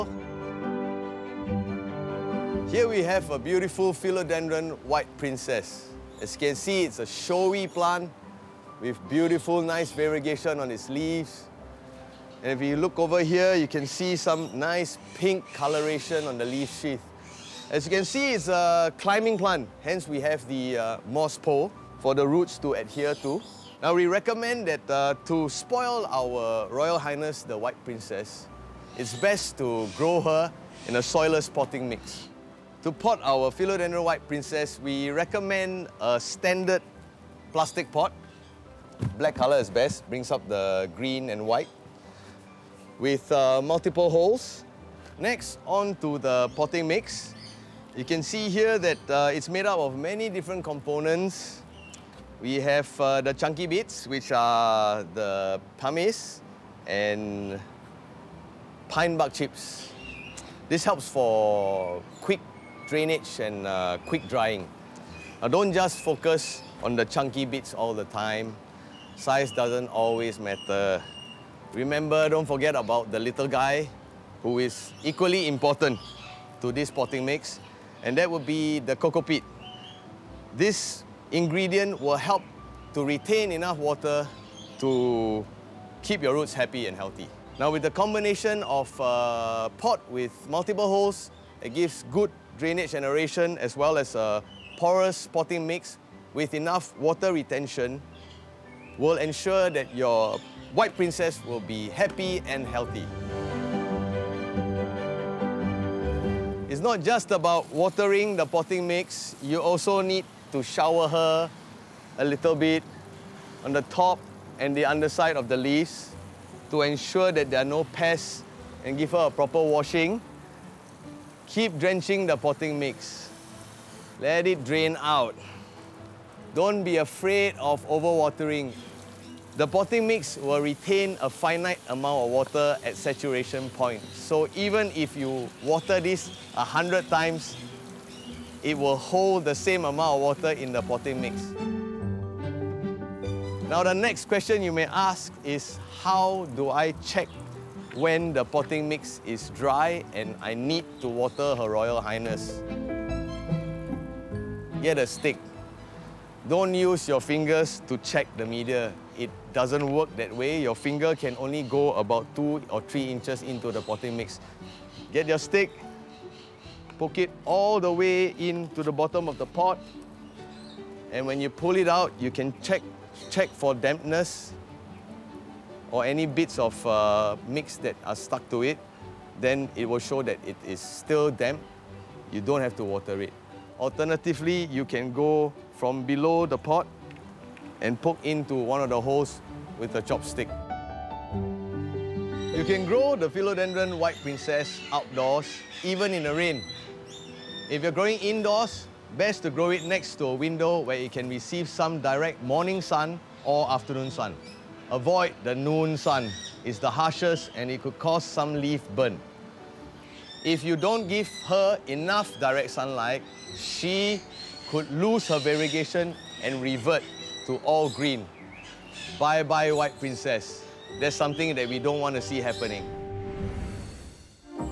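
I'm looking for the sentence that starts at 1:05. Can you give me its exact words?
Now, don't just focus on the chunky bits all the time.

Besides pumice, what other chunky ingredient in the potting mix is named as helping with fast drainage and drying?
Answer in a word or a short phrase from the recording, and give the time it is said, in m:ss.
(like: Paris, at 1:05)
pine bark chips, at 0:58.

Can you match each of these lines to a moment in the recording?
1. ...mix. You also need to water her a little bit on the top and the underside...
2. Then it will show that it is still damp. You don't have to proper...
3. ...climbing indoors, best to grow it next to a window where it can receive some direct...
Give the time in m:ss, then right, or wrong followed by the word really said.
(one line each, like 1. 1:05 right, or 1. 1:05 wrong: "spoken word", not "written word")
1. 1:48 wrong: "shower", not "water"
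2. 2:59 wrong: "water", not "proper"
3. 3:17 wrong: "growing", not "climbing".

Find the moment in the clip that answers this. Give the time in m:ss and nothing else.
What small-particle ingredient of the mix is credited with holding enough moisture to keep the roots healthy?
1:18.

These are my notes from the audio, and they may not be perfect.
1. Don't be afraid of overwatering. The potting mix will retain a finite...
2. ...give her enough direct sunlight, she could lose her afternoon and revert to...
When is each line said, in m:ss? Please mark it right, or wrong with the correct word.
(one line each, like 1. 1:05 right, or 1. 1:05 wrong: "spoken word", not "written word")
1. 2:06 right
2. 3:31 wrong: "variegation", not "afternoon".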